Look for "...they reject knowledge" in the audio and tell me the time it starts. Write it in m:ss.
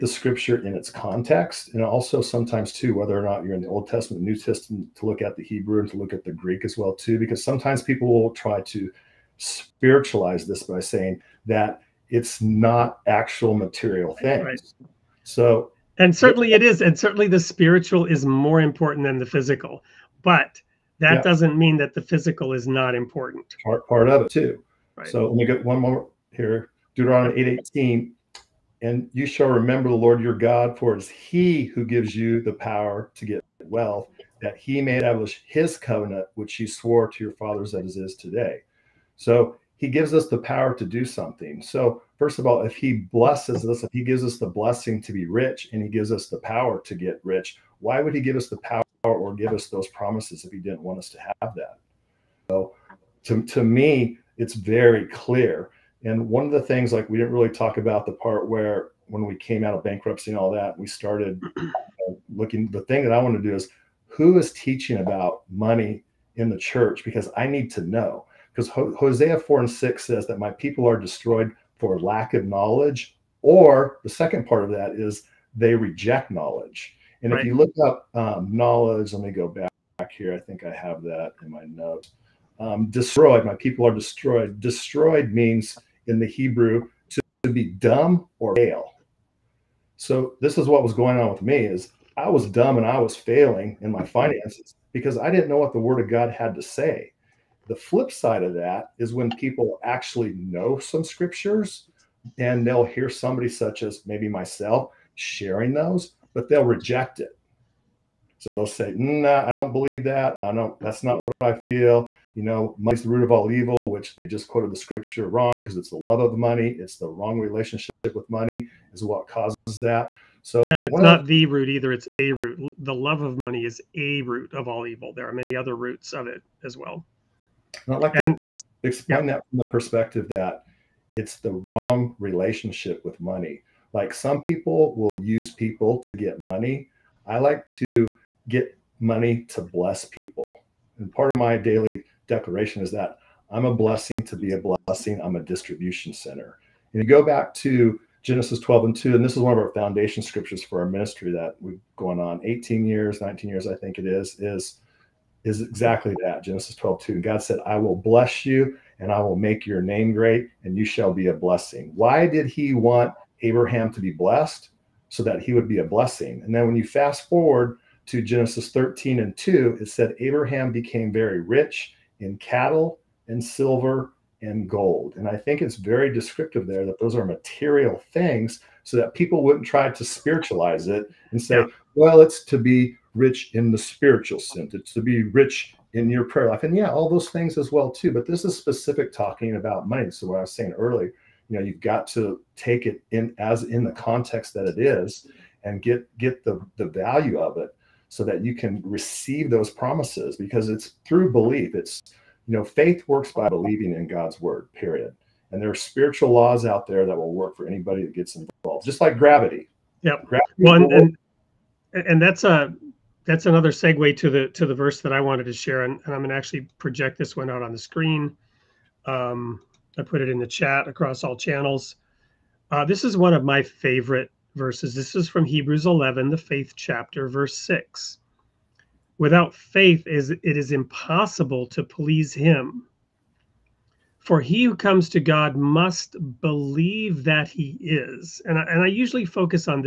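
1:15.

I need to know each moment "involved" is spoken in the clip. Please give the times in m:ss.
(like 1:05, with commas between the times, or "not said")
3:28.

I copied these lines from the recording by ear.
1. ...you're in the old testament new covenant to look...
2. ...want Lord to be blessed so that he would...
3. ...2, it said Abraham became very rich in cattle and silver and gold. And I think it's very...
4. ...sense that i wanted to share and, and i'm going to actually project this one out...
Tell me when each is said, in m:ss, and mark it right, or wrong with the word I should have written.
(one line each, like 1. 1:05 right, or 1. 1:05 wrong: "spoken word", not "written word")
1. 0:03 wrong: "testament", not "covenant"
2. 2:42 wrong: "Abraham", not "Lord"
3. 2:49 right
4. 3:34 wrong: "verse", not "sense".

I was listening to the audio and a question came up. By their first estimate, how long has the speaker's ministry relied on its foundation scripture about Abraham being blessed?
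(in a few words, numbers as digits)
18 years.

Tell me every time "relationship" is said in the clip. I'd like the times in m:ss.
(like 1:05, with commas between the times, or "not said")
1:57, 2:12.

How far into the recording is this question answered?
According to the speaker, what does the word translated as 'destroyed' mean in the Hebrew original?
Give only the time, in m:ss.
1:27.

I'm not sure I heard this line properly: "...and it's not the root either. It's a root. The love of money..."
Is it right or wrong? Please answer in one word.
right.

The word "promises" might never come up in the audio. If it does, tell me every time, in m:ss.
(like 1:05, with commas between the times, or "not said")
0:49, 3:19.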